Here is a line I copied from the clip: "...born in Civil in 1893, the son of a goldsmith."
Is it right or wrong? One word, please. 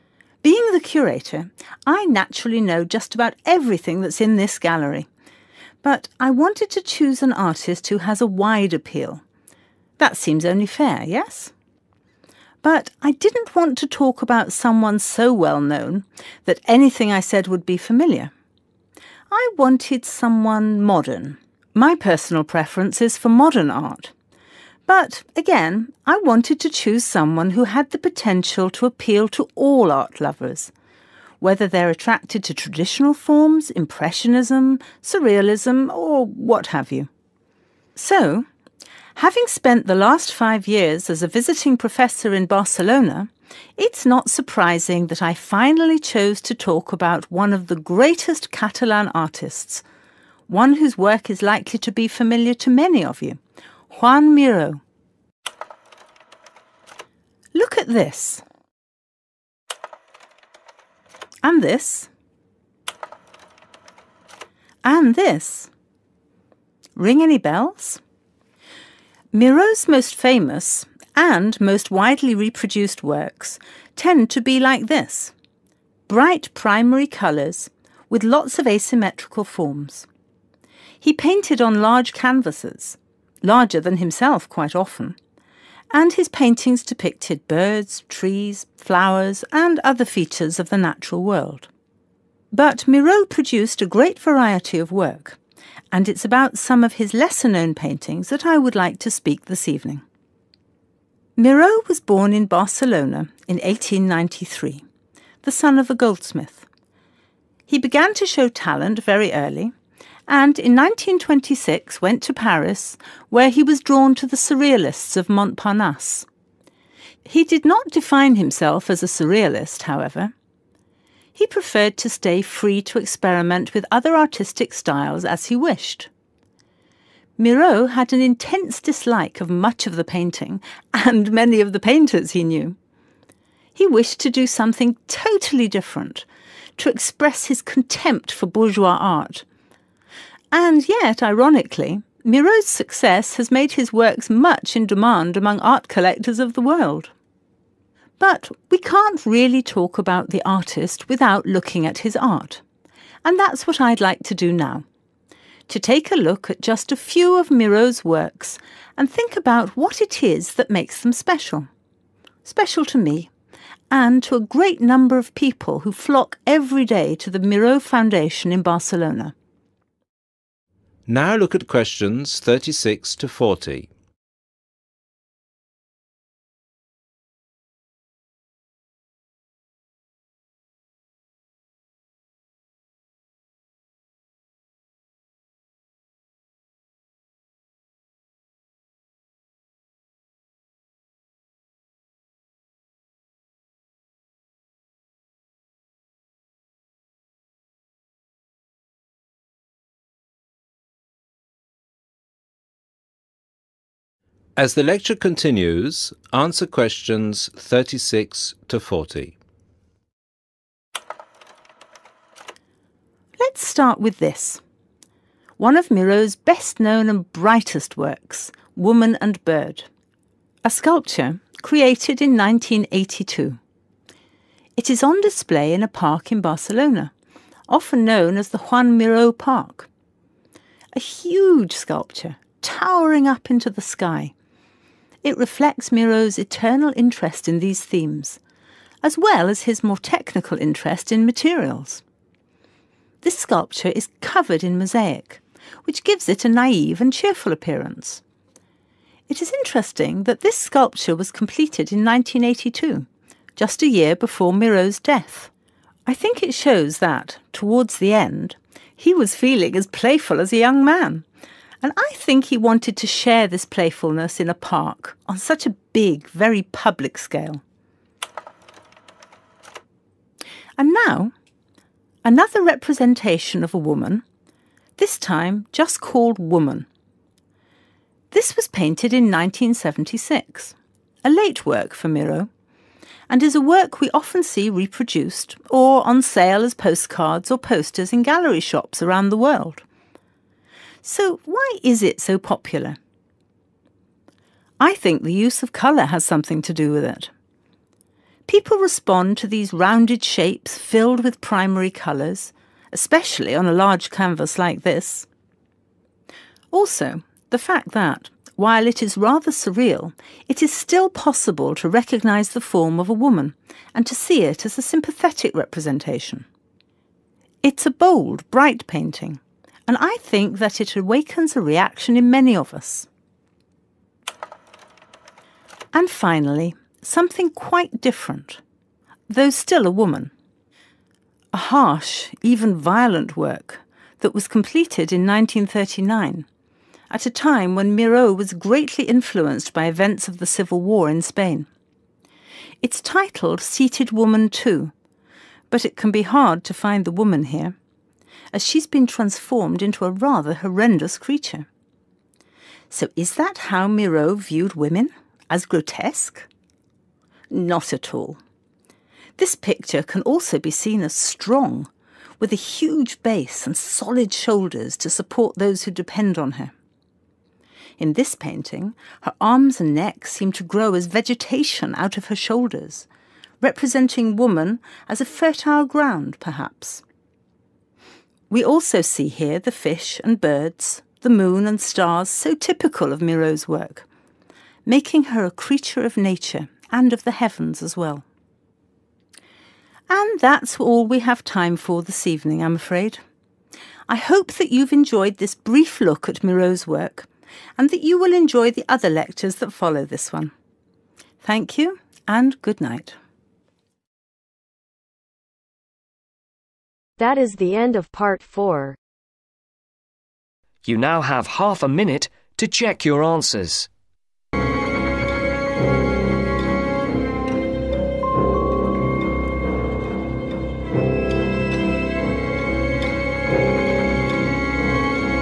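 wrong.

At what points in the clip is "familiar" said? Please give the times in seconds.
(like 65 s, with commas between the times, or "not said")
17 s, 52 s.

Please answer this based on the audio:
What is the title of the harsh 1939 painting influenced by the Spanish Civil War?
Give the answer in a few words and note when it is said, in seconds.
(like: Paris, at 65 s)
Seated Woman 2, at 343 s.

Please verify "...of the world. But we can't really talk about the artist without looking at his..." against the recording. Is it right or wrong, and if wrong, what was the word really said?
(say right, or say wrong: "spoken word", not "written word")
right.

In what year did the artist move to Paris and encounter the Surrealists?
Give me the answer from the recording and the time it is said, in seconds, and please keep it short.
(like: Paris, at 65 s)
1926, at 110 s.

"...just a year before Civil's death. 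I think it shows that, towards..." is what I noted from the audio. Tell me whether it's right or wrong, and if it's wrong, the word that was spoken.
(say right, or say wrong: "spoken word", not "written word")
wrong: "Miro", not "Civil".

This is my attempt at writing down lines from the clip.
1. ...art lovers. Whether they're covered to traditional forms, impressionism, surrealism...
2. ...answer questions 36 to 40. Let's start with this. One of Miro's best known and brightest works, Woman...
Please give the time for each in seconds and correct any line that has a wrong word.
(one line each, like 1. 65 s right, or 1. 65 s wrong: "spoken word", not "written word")
1. 29 s wrong: "attracted", not "covered"
2. 206 s right.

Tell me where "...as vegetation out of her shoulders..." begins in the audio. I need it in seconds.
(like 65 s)
370 s.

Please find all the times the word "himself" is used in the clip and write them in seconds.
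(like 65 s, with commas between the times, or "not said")
83 s, 118 s.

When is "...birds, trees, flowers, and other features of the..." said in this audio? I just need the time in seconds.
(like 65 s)
87 s.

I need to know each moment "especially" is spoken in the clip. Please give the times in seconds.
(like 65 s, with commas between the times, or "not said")
302 s.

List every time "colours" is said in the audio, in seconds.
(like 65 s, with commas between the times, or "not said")
77 s, 295 s, 301 s.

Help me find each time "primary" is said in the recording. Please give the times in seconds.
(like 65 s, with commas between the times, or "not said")
76 s, 301 s.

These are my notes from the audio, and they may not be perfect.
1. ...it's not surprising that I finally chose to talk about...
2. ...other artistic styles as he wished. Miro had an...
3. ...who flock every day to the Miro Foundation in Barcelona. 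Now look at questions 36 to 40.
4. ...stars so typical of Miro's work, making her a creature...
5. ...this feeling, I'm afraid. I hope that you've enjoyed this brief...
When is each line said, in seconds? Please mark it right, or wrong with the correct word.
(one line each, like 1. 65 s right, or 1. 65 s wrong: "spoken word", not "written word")
1. 43 s right
2. 123 s right
3. 165 s right
4. 381 s right
5. 392 s wrong: "evening", not "feeling".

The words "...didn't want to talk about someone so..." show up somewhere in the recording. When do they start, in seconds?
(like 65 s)
13 s.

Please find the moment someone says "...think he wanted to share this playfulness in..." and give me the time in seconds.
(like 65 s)
262 s.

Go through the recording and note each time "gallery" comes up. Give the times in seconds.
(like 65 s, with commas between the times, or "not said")
4 s, 288 s.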